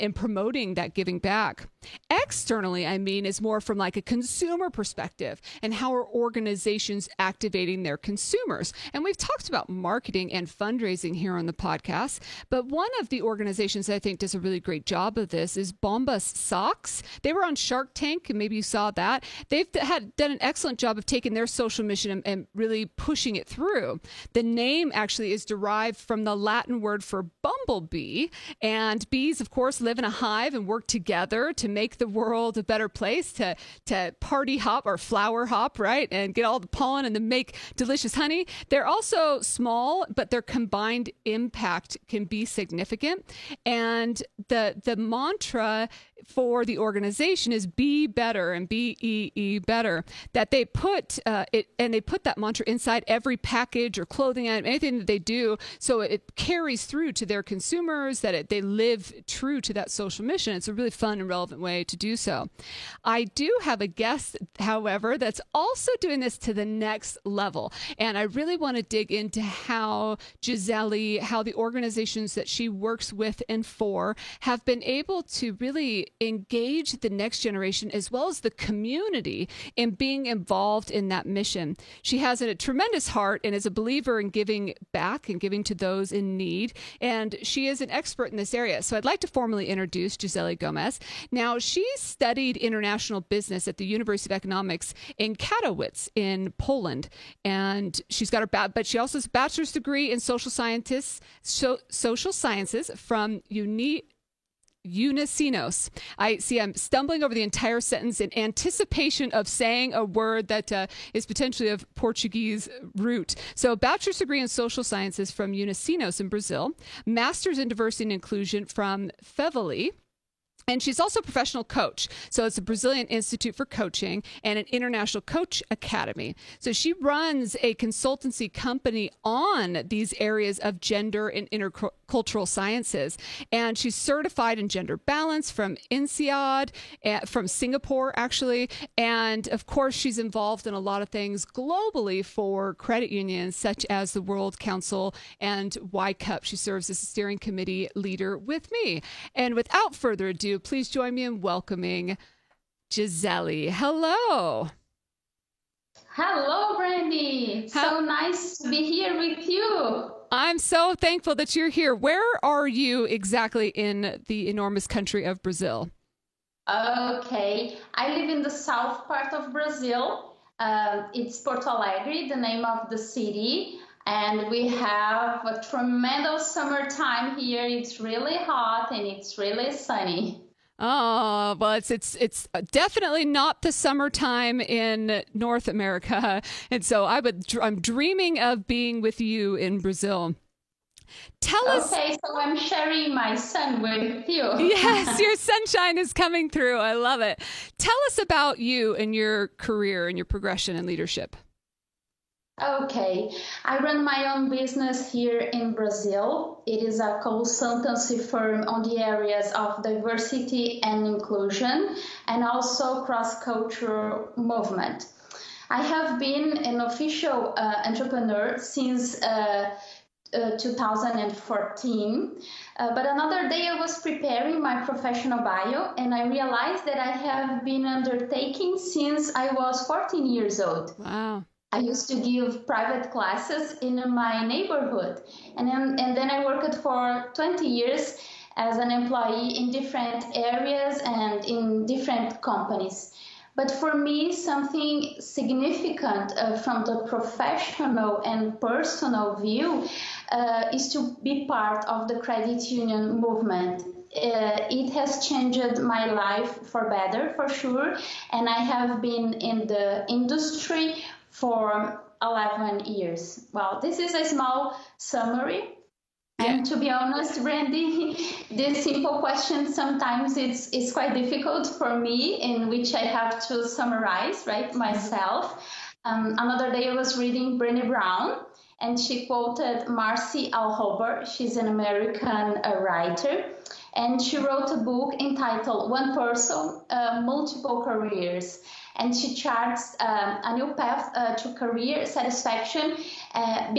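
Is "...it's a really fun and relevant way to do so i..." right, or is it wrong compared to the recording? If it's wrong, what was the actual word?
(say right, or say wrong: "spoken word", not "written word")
right.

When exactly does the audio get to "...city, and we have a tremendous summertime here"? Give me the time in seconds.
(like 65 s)
172 s.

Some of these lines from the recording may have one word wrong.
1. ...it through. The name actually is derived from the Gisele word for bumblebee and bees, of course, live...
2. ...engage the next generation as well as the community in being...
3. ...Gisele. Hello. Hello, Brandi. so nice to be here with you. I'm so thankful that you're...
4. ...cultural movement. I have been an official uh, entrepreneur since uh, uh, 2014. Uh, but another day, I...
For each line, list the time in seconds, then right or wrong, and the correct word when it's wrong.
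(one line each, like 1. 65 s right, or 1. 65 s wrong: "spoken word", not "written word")
1. 23 s wrong: "Latin", not "Gisele"
2. 76 s right
3. 152 s right
4. 213 s right.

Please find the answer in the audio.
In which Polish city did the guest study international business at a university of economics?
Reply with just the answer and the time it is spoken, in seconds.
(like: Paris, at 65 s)
Katowice, at 95 s.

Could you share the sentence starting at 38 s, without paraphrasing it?
They're also small, but their combined impact can be significant.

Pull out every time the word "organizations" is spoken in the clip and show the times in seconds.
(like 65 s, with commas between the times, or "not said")
6 s, 13 s, 46 s, 71 s.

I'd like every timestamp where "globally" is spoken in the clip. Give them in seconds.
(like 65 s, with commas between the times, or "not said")
141 s.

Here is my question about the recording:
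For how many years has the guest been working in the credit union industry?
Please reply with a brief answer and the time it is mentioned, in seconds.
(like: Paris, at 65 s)
11, at 262 s.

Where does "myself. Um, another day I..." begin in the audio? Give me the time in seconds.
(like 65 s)
274 s.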